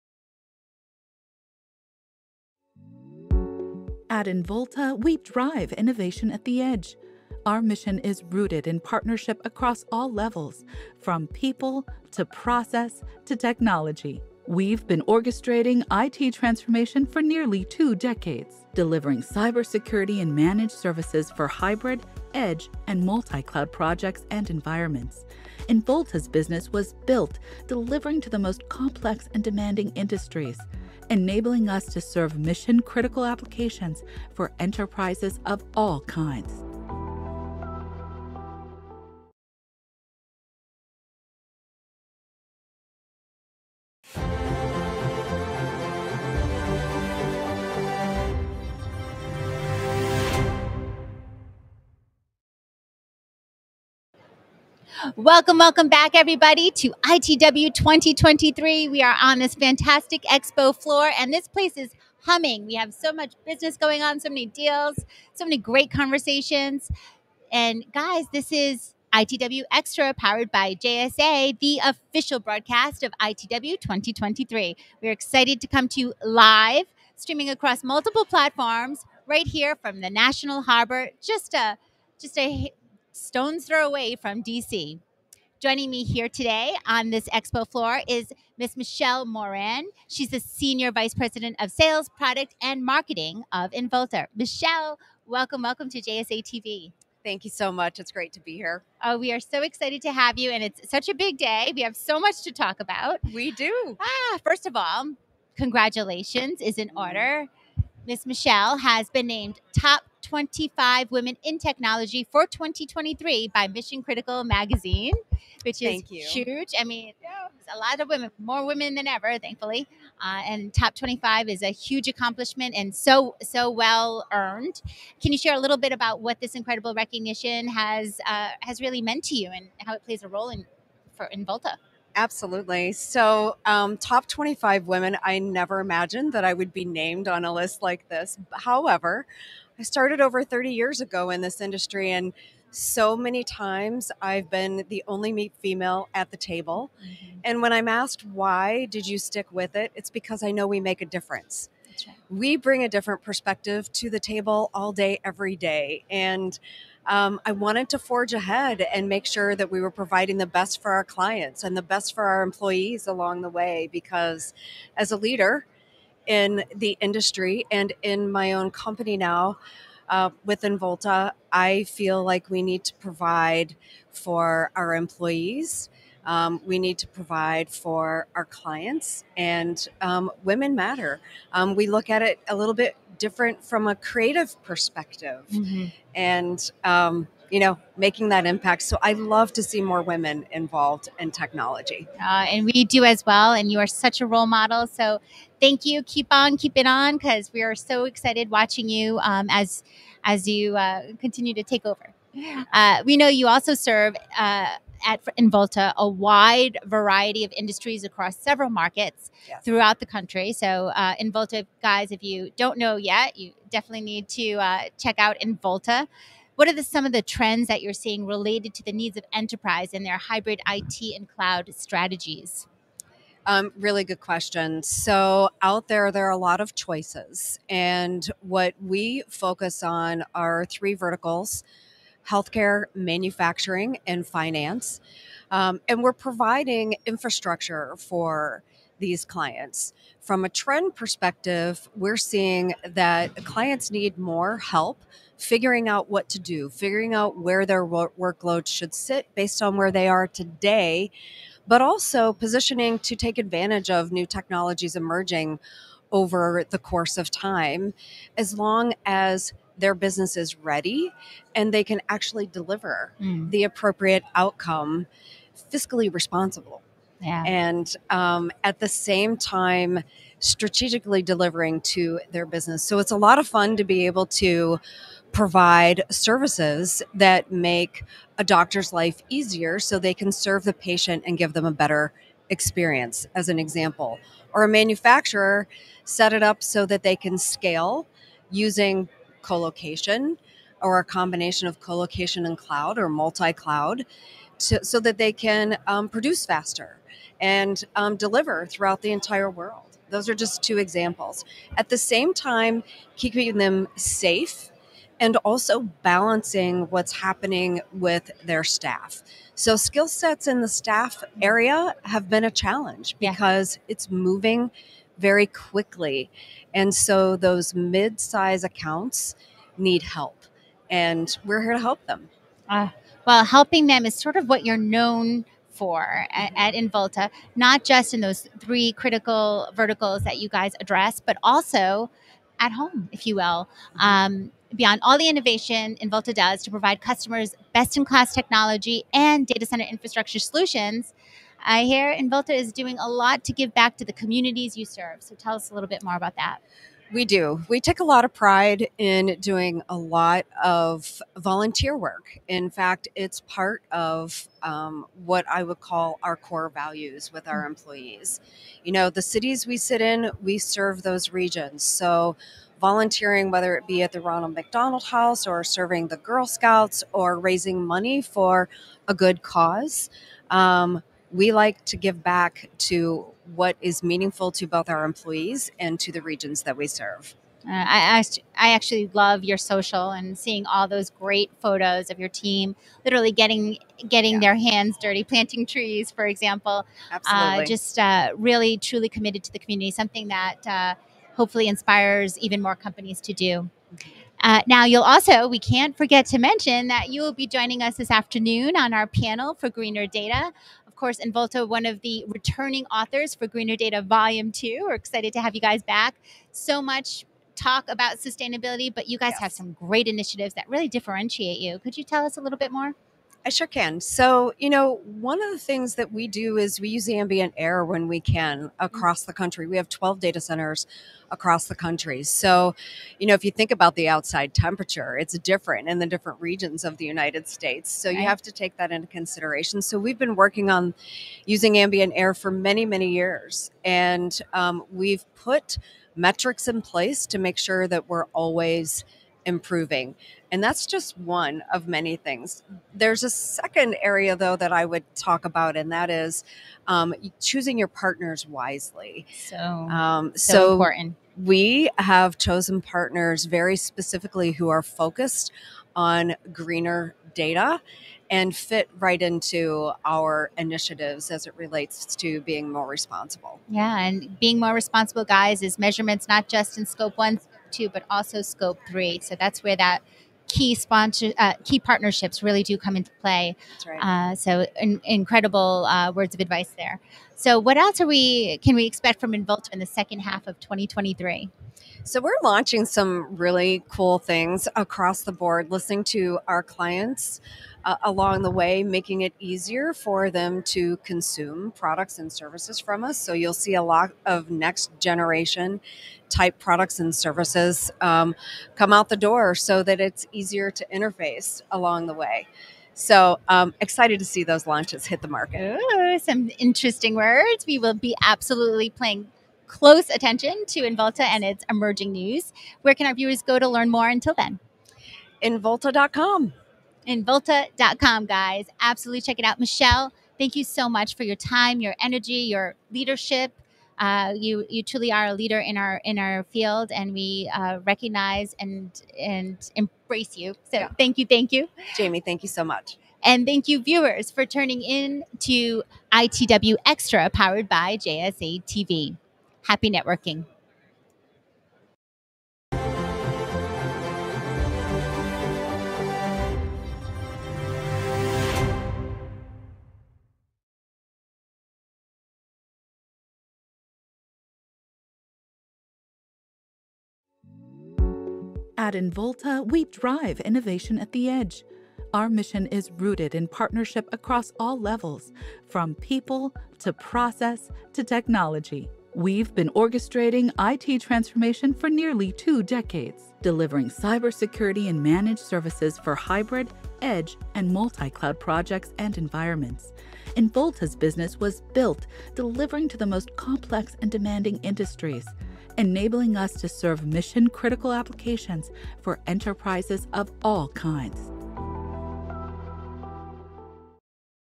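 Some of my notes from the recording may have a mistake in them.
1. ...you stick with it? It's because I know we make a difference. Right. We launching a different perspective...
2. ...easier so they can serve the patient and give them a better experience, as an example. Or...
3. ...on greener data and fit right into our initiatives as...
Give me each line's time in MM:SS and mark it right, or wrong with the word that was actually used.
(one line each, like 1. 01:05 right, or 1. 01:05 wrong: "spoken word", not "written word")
1. 02:29 wrong: "bring", not "launching"
2. 04:39 right
3. 07:35 right.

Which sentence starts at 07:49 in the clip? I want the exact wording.
So that's where that key sponsor uh, key partnerships really do come into play.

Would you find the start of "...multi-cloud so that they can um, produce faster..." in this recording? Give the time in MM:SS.
04:53.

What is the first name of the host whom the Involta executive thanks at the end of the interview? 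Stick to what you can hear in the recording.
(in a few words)
Jamie.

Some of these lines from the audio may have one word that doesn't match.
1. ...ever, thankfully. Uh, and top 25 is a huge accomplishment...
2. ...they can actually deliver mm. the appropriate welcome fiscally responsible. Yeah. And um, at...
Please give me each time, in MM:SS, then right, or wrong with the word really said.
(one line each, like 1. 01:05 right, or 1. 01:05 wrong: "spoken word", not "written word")
1. 01:59 right
2. 04:21 wrong: "outcome", not "welcome".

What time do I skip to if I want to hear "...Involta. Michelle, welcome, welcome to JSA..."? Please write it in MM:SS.
01:33.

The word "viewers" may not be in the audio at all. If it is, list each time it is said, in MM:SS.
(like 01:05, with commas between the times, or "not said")
08:33, 08:53.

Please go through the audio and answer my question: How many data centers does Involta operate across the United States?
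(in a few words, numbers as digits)
12.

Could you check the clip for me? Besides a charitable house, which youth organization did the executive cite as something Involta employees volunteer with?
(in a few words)
Girl Scouts.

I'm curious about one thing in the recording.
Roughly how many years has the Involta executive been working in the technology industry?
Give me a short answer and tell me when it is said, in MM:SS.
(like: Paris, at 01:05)
30 years, at 02:20.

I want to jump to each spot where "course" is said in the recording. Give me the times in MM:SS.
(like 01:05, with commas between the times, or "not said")
04:16, 06:41.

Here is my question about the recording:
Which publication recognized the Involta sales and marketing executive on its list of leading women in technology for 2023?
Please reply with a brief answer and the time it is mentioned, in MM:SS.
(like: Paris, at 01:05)
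Mission Critical Magazine, at 01:53.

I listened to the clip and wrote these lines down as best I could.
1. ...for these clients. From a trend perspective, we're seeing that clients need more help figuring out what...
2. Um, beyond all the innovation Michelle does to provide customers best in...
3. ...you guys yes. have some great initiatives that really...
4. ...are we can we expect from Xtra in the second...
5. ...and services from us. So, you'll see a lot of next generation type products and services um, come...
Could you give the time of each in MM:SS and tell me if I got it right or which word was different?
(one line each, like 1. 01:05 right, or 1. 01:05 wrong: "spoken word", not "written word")
1. 03:57 right
2. 05:33 wrong: "Involta", not "Michelle"
3. 06:49 right
4. 07:58 wrong: "Involta", not "Xtra"
5. 08:12 right.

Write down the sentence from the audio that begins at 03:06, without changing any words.
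and um, you know, making that impact.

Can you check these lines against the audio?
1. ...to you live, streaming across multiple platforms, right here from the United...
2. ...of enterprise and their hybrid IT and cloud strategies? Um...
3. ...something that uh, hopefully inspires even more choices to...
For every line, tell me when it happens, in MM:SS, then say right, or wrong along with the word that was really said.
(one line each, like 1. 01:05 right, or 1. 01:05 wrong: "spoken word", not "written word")
1. 01:15 wrong: "National", not "United"
2. 03:39 right
3. 06:29 wrong: "companies", not "choices".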